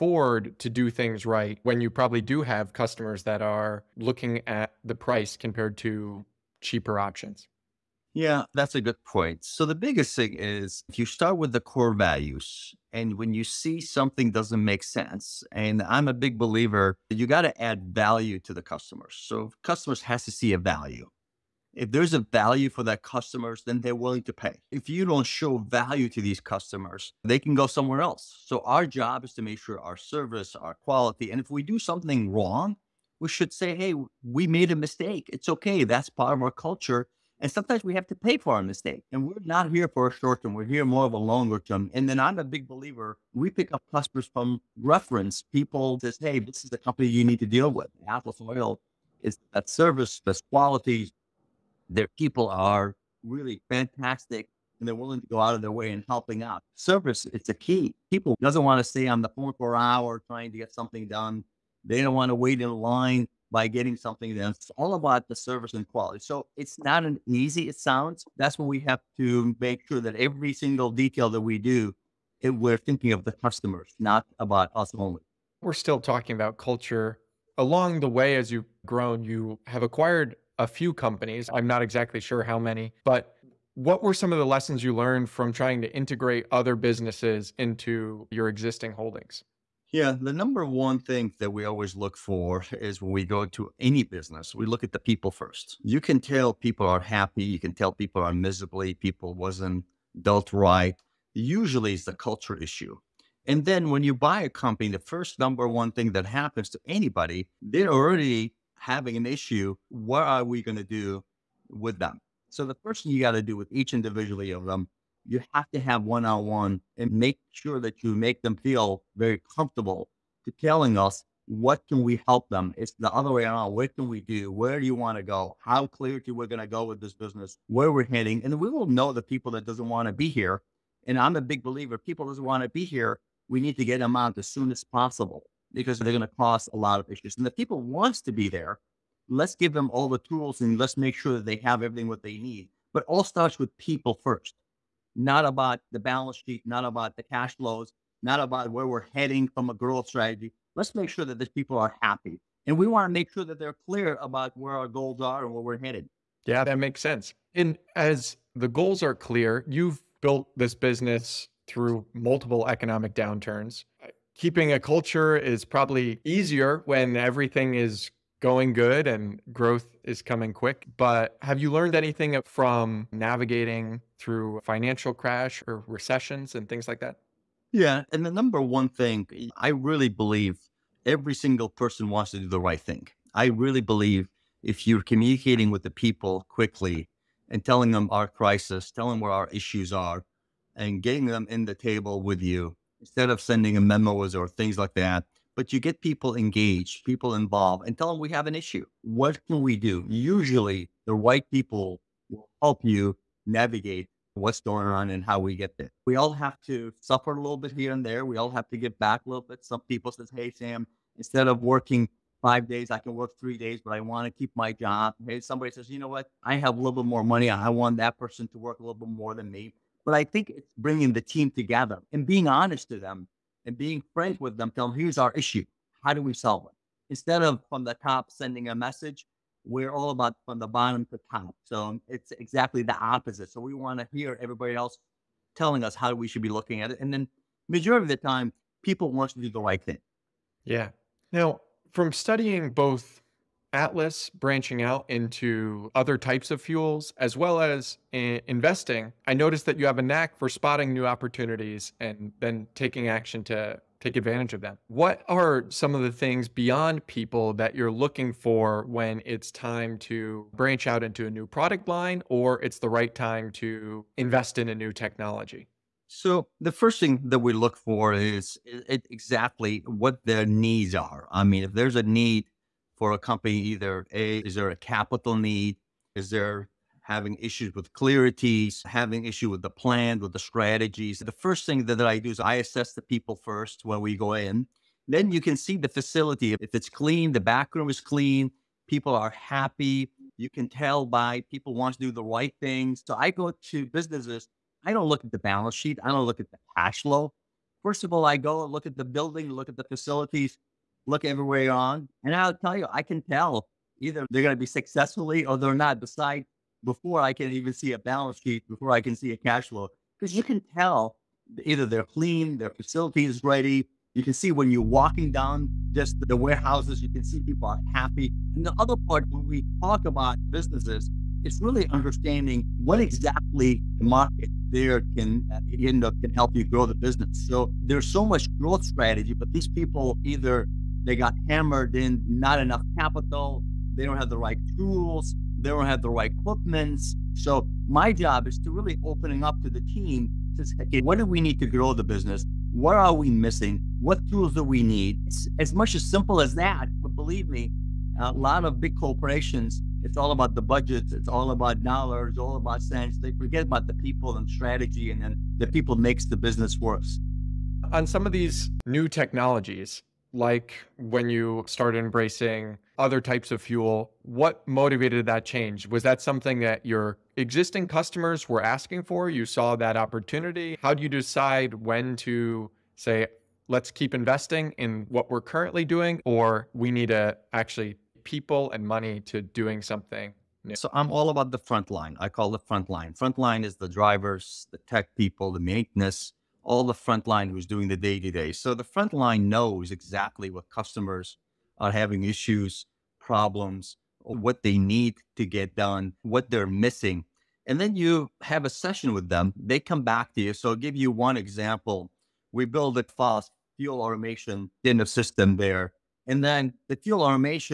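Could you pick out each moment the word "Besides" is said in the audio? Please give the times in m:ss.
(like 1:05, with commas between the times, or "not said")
5:05.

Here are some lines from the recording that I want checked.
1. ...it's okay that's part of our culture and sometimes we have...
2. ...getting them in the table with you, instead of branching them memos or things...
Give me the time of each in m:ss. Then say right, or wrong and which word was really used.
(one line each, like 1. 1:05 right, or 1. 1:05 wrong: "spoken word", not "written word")
1. 0:35 right
2. 3:11 wrong: "sending", not "branching".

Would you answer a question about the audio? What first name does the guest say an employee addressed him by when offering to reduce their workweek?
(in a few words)
Sam.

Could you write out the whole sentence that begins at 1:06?
So it's not an easy, it sounds.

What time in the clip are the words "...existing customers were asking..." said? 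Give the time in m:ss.
6:07.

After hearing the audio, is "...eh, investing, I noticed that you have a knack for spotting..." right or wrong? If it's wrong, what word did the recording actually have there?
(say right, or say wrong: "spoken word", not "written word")
right.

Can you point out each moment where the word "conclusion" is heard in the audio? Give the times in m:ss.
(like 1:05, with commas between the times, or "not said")
not said.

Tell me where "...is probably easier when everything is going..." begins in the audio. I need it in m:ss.
2:45.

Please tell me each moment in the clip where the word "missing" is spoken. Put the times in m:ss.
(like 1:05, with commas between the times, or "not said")
5:43, 6:36.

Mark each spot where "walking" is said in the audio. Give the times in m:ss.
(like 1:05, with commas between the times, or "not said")
5:14.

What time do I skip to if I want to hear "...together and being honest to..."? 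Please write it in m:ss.
3:41.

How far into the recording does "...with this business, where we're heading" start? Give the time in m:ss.
2:06.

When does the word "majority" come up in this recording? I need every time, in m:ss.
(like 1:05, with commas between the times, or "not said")
3:57.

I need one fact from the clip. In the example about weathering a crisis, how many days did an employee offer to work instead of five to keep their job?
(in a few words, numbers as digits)
3.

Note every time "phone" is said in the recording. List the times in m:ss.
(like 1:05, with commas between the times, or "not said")
0:59.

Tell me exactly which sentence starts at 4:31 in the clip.
I mean, if there's a need for a company either A, is there a capital need?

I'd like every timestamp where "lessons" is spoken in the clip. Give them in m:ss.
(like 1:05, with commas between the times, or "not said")
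1:24.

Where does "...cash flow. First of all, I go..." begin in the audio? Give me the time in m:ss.
4:56.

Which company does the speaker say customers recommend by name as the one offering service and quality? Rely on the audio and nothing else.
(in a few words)
Atlas Oil.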